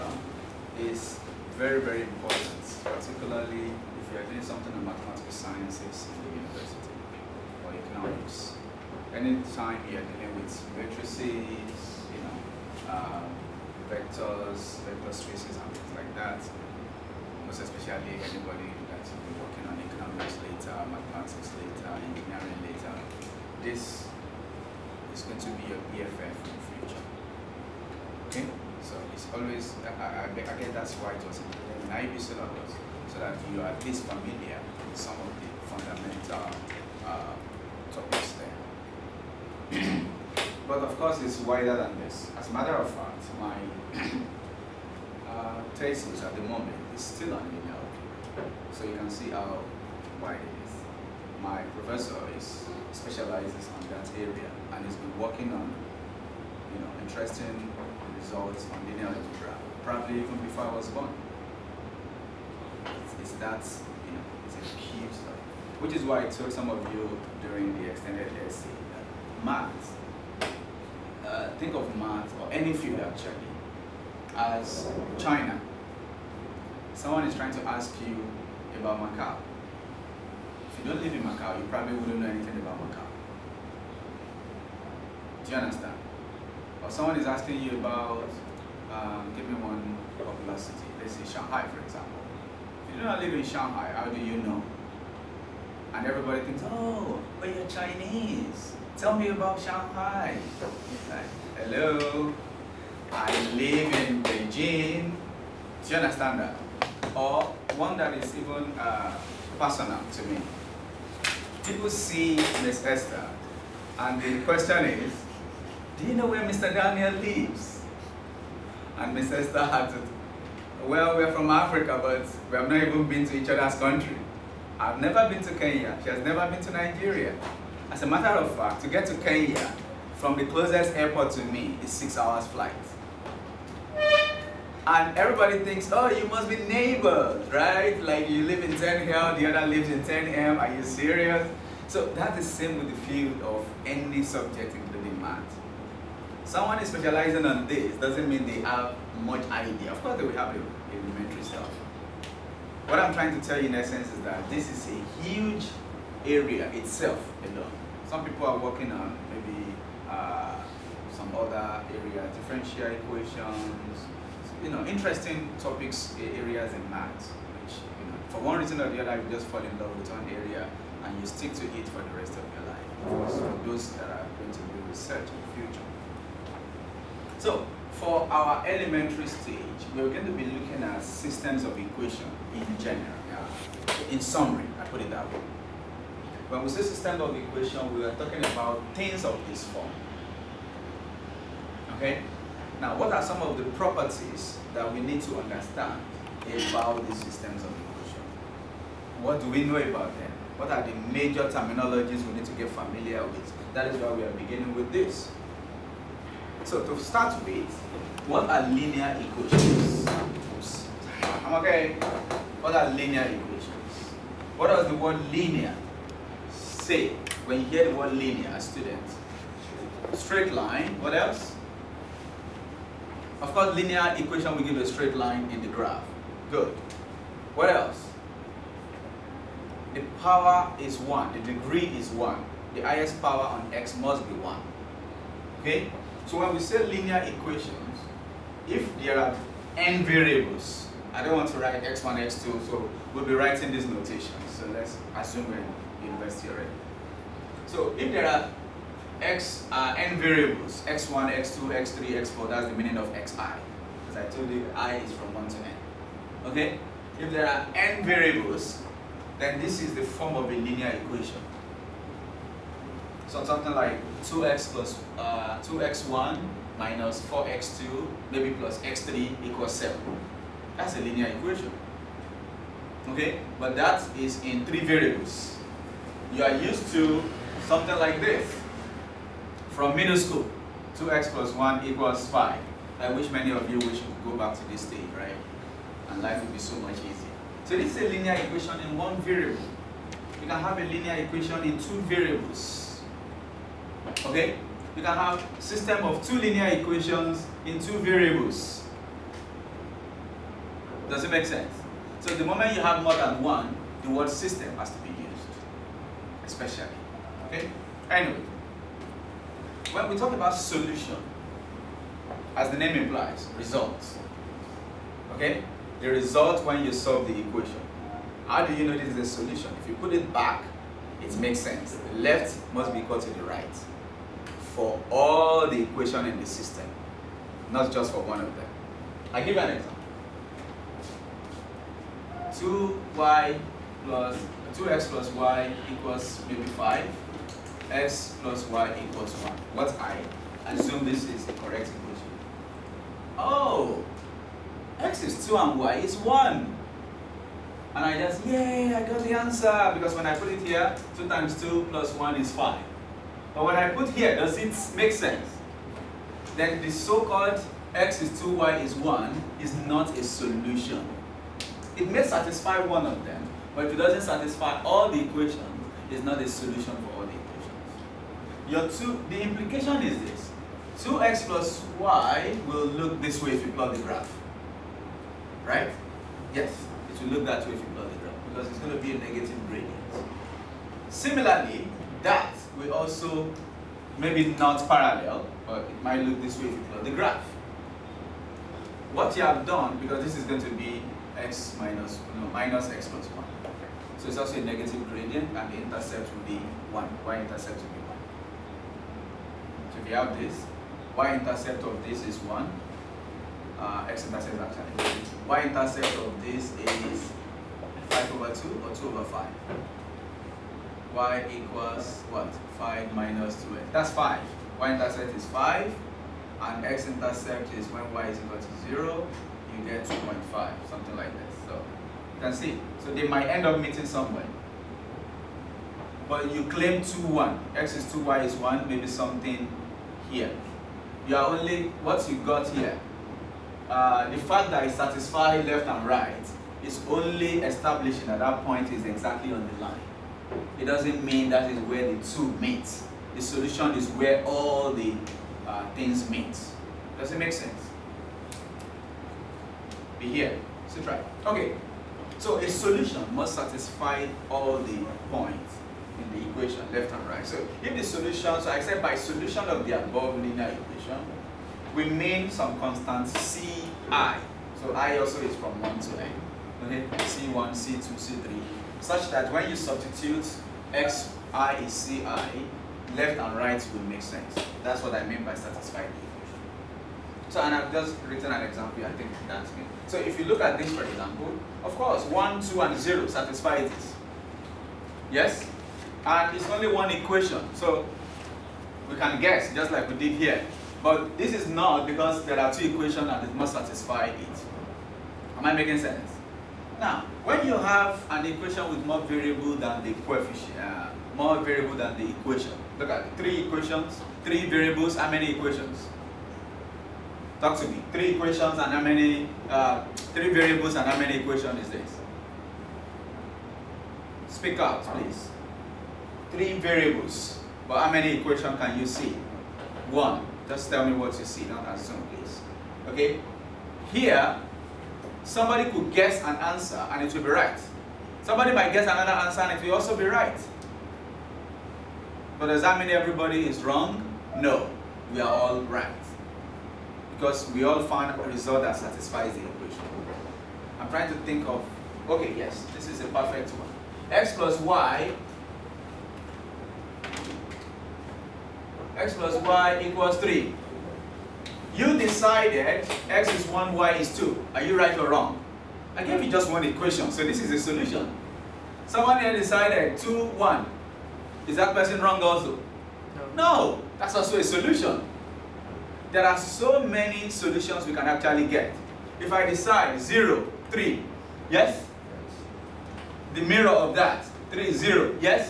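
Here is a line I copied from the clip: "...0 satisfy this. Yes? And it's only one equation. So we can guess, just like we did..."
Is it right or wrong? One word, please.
right.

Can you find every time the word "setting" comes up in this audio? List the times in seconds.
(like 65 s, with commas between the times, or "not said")
not said.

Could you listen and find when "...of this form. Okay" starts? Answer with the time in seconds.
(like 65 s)
189 s.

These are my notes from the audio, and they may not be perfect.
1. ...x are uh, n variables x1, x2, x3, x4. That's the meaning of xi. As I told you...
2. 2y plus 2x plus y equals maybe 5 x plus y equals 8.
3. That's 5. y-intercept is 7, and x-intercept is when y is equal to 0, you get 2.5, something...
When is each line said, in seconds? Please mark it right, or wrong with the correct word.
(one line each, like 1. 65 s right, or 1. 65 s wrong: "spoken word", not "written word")
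1. 249 s right
2. 333 s wrong: "1", not "8"
3. 413 s wrong: "5", not "7".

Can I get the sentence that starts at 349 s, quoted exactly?
Because when I put it here, 2 times 2 plus 1 is 5.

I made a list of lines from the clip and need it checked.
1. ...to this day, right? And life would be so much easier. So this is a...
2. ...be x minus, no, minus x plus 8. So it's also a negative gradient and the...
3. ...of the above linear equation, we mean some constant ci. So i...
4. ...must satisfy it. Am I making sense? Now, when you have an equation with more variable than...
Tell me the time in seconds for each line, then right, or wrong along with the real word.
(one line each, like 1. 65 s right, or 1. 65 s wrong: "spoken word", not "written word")
1. 284 s right
2. 390 s wrong: "1", not "8"
3. 459 s right
4. 493 s right.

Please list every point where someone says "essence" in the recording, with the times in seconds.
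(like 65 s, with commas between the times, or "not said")
153 s.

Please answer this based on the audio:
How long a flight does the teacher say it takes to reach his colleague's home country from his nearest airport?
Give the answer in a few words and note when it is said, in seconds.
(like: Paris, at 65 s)
6 hours, at 131 s.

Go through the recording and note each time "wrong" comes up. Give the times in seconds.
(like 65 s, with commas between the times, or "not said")
533 s, 555 s, 562 s.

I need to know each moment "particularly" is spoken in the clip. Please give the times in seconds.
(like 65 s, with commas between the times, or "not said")
2 s.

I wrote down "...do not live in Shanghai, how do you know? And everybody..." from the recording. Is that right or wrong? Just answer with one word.
right.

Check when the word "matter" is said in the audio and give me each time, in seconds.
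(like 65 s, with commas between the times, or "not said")
42 s, 128 s.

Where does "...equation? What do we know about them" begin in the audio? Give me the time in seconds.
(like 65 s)
197 s.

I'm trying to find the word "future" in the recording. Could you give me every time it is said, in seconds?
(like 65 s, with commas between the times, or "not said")
26 s, 175 s.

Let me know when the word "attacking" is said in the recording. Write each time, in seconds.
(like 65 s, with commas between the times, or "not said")
not said.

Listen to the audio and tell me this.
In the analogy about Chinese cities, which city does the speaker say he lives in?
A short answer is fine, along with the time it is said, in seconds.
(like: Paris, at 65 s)
Beijing, at 104 s.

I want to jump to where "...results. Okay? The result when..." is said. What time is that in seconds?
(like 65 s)
313 s.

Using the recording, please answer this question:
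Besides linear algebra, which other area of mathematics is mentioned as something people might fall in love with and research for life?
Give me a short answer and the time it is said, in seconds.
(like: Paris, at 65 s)
differential equations, at 162 s.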